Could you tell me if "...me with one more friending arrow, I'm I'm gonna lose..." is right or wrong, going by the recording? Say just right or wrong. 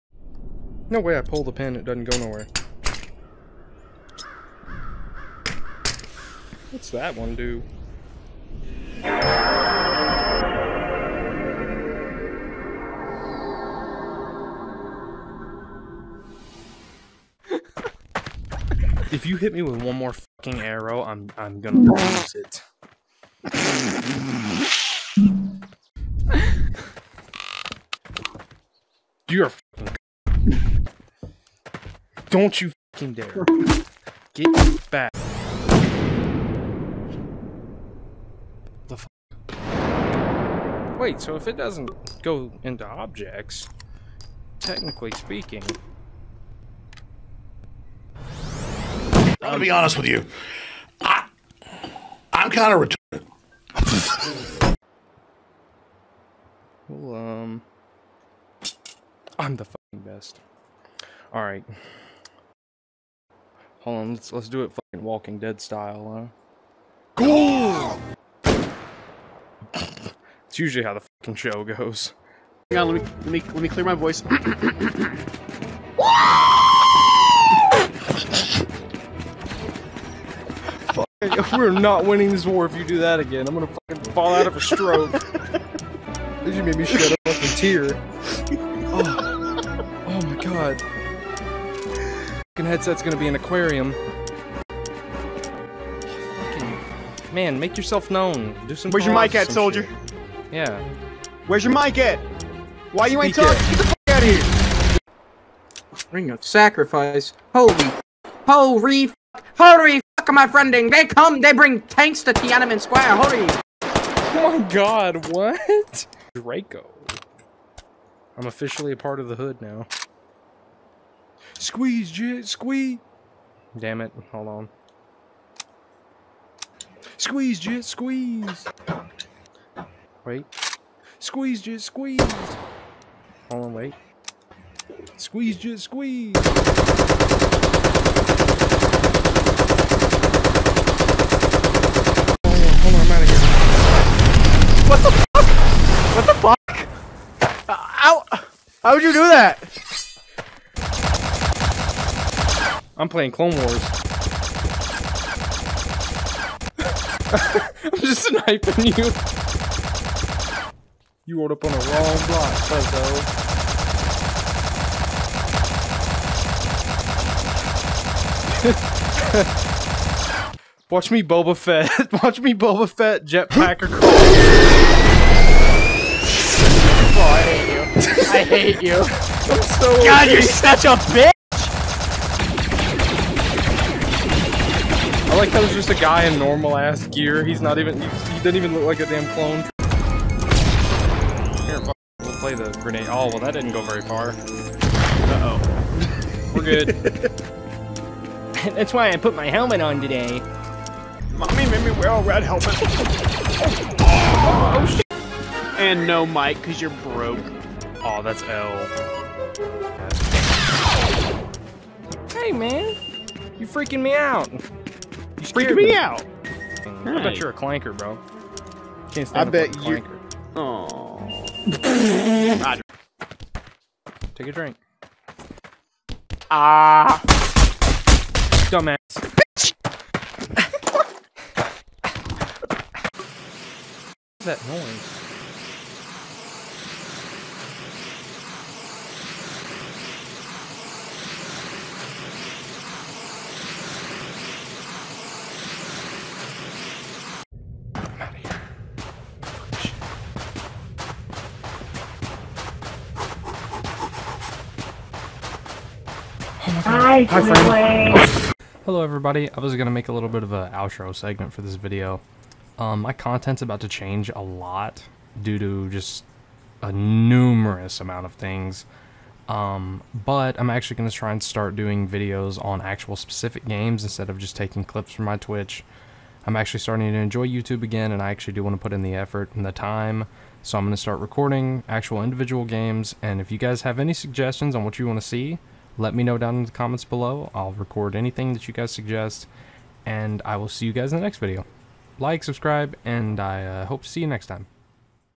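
wrong.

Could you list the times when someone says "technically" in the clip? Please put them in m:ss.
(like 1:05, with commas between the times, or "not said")
0:44.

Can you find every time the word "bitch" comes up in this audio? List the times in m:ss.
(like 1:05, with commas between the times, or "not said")
3:01, 3:49.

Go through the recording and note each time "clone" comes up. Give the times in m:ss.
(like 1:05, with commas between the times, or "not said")
2:33, 3:09.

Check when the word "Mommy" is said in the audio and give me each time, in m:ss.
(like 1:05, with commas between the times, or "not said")
3:21.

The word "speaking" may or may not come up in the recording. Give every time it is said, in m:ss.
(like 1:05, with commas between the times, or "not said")
0:45.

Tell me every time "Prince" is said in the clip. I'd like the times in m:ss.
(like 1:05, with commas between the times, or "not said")
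not said.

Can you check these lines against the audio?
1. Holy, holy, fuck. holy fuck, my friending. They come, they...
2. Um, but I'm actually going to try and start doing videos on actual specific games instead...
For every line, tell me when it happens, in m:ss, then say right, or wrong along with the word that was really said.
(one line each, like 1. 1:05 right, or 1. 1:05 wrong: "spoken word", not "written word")
1. 1:47 right
2. 4:29 right.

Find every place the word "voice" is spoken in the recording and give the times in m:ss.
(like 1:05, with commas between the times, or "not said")
1:13.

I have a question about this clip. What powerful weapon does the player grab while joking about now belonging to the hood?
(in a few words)
Draco.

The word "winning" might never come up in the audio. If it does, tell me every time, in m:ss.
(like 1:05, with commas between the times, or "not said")
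1:22.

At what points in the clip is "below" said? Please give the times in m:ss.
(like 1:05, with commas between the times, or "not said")
4:47.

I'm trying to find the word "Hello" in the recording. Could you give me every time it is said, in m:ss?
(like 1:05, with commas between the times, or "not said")
4:18.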